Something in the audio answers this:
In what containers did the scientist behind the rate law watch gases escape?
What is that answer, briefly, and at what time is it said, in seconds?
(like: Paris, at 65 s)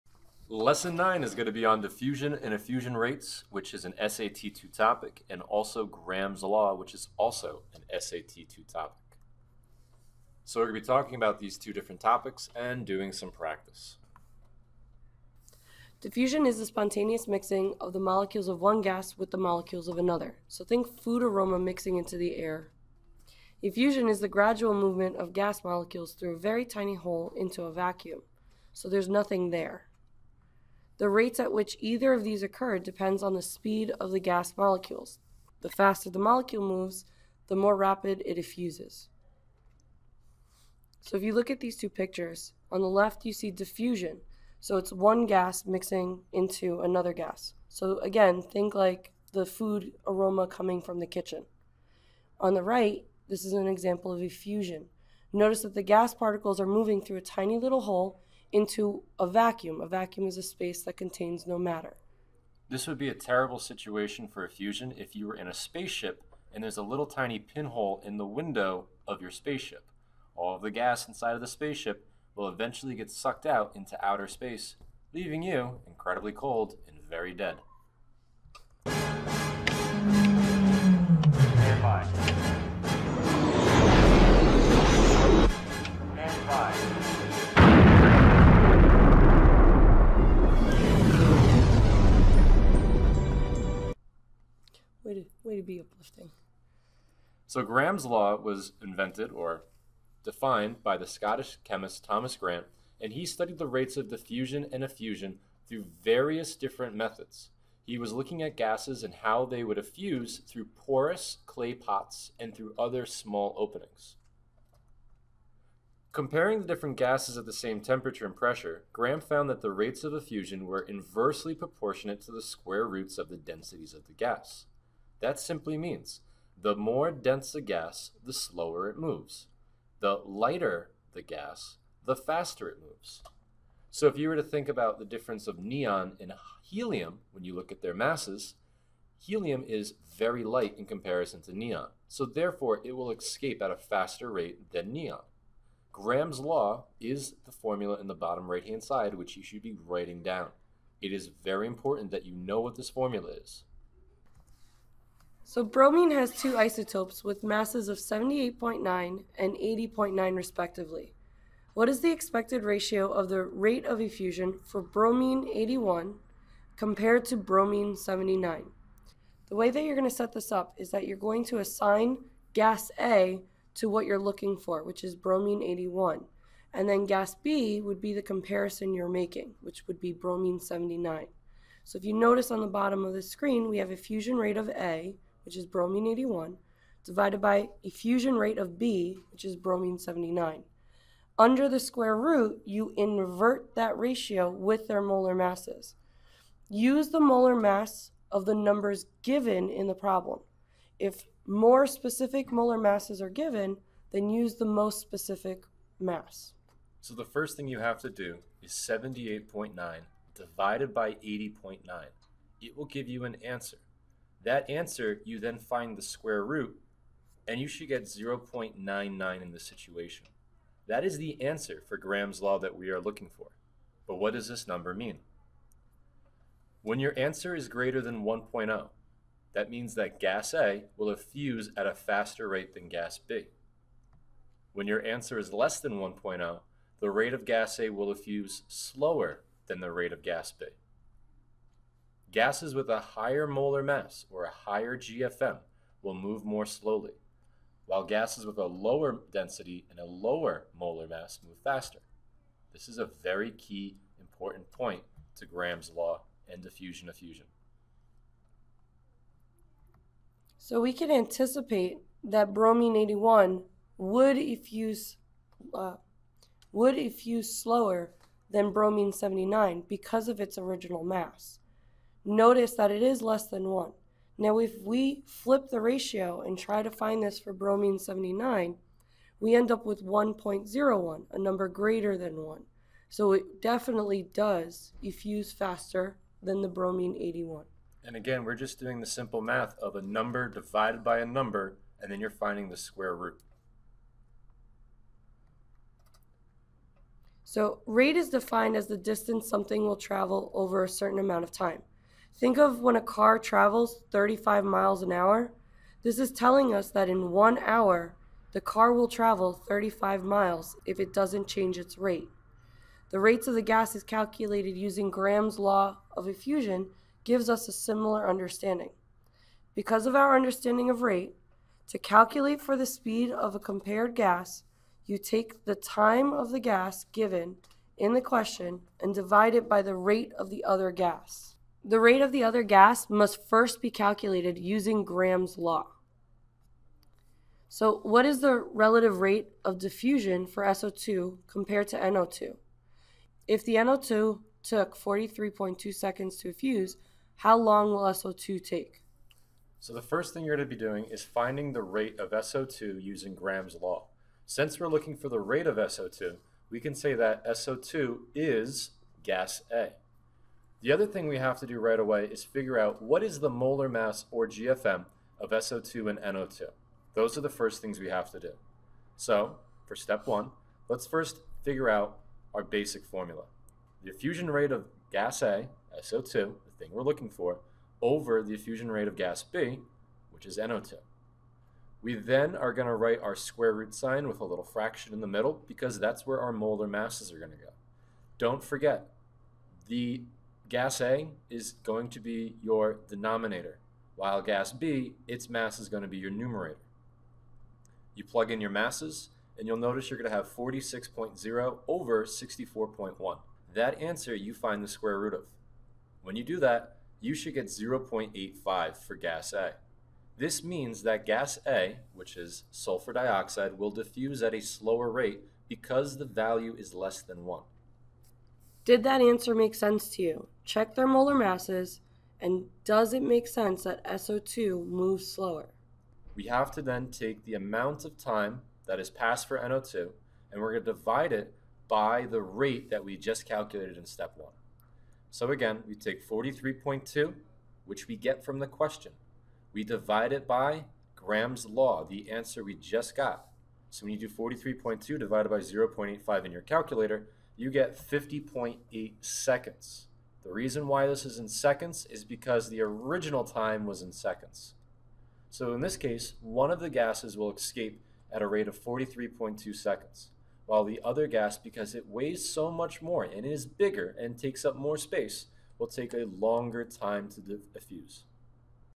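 porous clay pots, at 110 s.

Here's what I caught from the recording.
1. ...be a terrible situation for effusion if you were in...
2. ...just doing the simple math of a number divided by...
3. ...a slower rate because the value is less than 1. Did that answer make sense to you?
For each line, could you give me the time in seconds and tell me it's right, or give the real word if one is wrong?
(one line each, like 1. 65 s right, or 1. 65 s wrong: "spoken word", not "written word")
1. 62 s right
2. 288 s right
3. 414 s right.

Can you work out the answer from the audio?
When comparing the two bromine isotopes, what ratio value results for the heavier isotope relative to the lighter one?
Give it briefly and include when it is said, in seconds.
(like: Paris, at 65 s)
0.99, at 218 s.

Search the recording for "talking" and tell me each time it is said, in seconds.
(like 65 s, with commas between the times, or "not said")
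10 s.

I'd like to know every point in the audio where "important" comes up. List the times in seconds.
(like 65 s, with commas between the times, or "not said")
151 s, 254 s.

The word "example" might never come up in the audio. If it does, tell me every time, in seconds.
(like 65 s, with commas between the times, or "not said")
53 s.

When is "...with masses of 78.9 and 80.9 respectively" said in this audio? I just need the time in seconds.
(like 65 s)
157 s.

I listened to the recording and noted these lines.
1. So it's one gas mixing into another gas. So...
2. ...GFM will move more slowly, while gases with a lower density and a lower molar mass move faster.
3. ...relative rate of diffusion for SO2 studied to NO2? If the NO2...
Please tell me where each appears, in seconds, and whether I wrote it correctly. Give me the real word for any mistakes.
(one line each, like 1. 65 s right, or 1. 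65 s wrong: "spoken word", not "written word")
1. 44 s right
2. 244 s right
3. 338 s wrong: "compared", not "studied".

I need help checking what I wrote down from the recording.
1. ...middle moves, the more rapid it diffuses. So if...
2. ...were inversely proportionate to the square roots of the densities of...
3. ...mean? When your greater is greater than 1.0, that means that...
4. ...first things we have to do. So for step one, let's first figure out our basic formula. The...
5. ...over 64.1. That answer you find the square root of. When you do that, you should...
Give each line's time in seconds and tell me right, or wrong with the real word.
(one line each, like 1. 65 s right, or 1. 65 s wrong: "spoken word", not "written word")
1. 36 s wrong: "molecule", not "middle"
2. 120 s right
3. 224 s wrong: "answer", not "greater"
4. 367 s right
5. 401 s right.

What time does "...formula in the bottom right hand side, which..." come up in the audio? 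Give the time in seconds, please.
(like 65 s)
147 s.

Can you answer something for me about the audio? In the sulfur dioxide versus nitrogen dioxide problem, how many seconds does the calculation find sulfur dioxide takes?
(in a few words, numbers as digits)
50.8 seconds.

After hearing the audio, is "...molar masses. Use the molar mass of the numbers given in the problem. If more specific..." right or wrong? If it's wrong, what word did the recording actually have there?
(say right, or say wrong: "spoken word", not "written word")
right.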